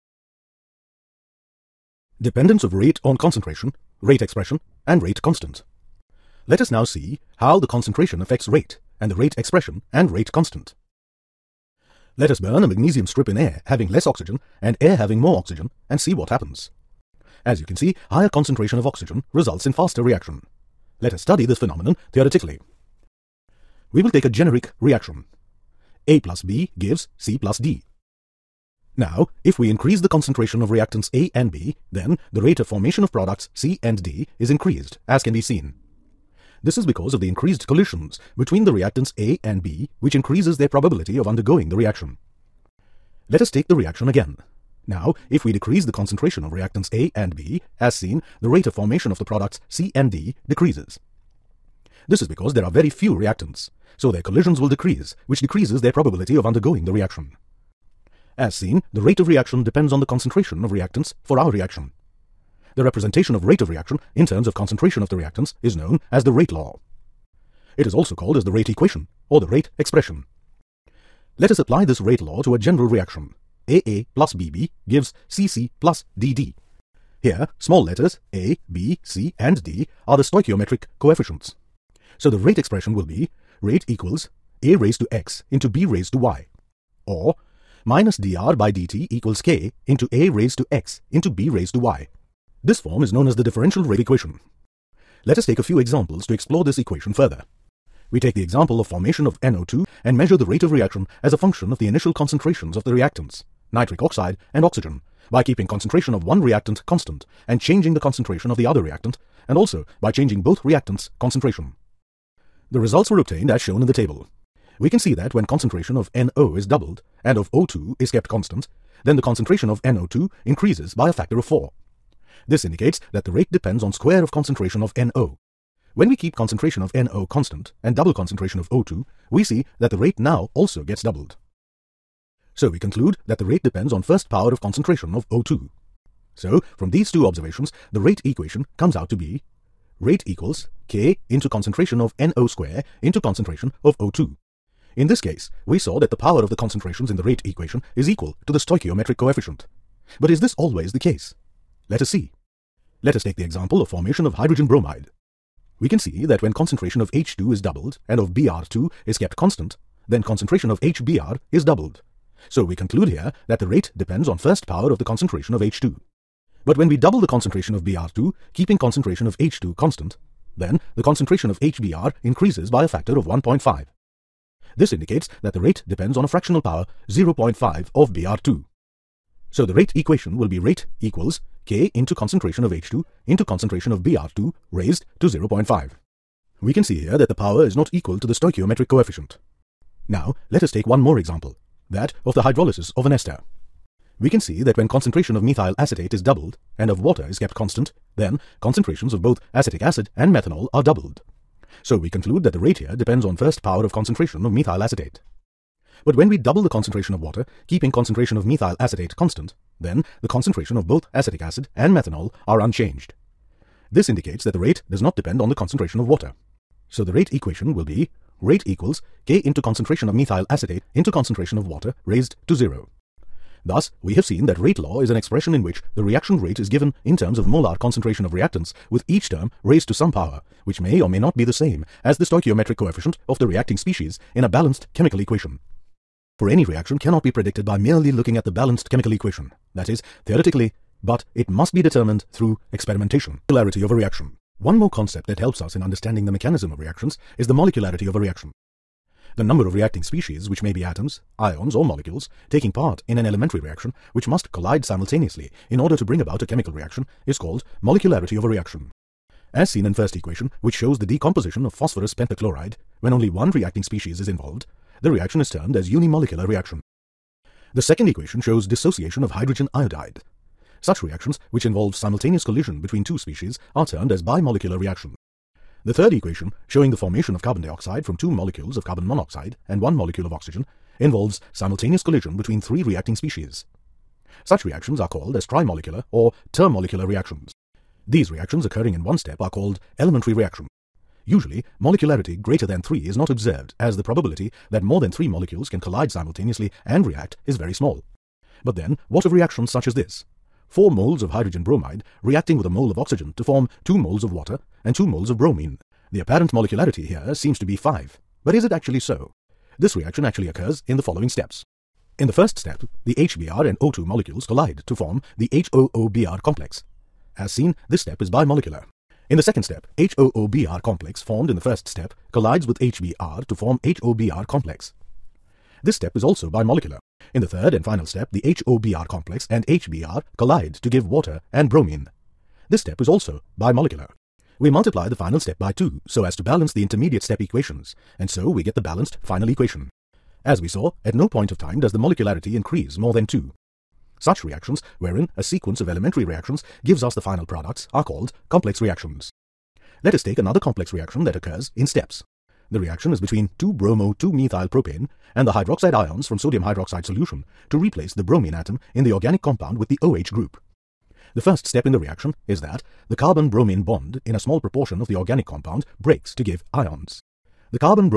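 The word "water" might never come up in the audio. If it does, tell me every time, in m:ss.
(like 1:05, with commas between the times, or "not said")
3:16, 3:27, 3:36, 3:41, 5:04, 5:31.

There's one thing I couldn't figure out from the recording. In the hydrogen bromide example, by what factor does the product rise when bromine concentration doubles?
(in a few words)
1.5.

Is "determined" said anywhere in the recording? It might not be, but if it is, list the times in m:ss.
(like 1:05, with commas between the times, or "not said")
4:01.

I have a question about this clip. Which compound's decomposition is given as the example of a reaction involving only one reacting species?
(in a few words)
Phosphorus pentachloride.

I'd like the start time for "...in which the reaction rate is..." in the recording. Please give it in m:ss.
3:45.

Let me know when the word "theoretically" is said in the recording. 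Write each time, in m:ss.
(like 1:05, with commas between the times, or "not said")
0:22, 4:00.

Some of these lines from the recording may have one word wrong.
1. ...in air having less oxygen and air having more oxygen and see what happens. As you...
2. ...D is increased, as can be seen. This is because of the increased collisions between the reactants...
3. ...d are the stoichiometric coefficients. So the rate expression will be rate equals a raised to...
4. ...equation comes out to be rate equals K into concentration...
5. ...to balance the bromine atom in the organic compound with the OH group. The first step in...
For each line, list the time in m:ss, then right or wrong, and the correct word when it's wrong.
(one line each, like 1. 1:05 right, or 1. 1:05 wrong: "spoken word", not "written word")
1. 0:13 right
2. 0:34 right
3. 1:19 right
4. 2:18 right
5. 5:57 wrong: "replace", not "balance".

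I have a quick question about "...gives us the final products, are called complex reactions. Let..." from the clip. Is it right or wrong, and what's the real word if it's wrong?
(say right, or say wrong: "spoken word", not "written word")
right.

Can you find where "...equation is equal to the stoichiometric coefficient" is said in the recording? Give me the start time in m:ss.
2:27.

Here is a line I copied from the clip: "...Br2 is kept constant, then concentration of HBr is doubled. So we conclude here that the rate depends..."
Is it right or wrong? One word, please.
right.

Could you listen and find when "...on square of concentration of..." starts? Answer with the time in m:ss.
2:03.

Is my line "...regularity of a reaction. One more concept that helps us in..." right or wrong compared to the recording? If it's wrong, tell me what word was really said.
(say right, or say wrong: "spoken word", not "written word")
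right.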